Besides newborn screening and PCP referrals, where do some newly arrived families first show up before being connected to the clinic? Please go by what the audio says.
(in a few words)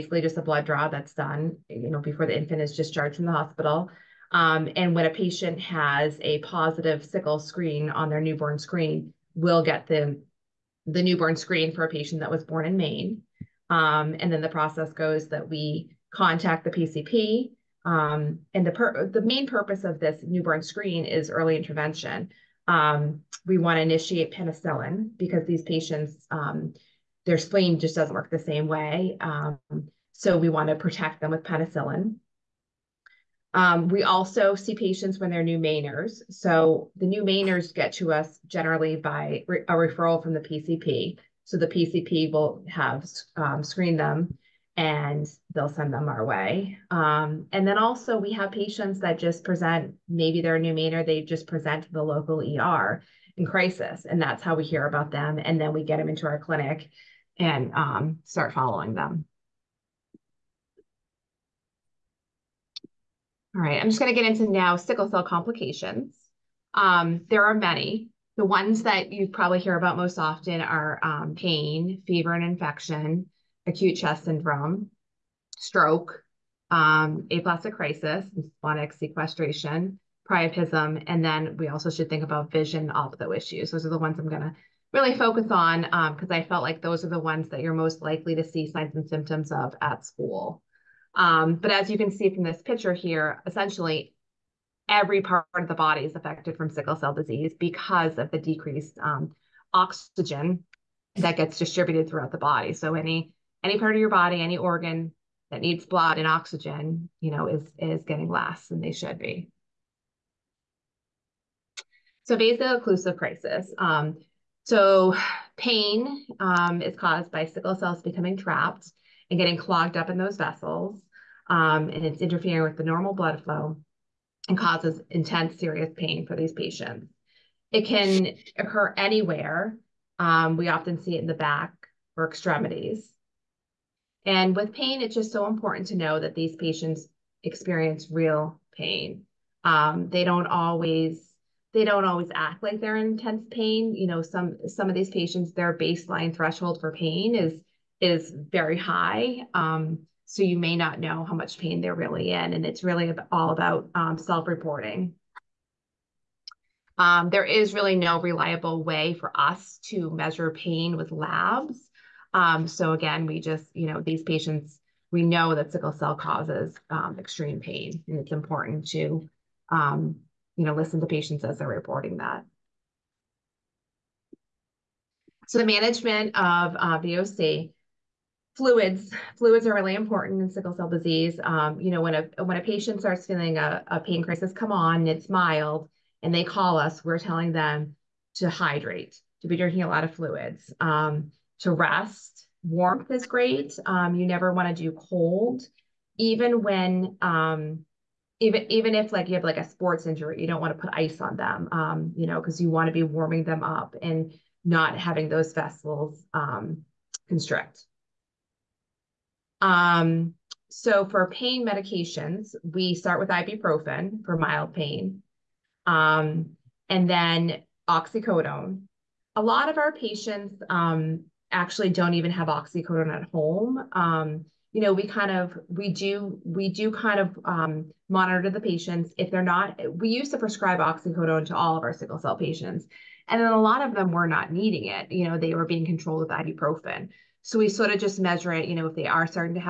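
The local ER.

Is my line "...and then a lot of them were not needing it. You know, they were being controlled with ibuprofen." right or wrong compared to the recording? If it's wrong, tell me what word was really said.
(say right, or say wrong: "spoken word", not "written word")
right.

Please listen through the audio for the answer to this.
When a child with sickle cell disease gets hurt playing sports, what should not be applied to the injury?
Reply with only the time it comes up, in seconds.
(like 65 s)
200 s.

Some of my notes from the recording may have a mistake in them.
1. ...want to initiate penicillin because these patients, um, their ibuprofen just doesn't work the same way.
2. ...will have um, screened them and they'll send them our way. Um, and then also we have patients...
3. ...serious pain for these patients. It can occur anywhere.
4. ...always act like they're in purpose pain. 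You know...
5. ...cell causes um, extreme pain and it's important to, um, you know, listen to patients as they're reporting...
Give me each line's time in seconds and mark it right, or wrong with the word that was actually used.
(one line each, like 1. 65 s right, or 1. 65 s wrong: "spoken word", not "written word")
1. 23 s wrong: "spleen", not "ibuprofen"
2. 42 s right
3. 125 s right
4. 142 s wrong: "intense", not "purpose"
5. 165 s right.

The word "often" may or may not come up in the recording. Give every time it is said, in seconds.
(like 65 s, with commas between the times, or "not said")
70 s, 130 s.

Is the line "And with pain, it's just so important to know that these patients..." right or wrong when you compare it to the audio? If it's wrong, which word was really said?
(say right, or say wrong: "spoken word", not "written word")
right.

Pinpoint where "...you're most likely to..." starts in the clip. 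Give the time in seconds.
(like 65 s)
87 s.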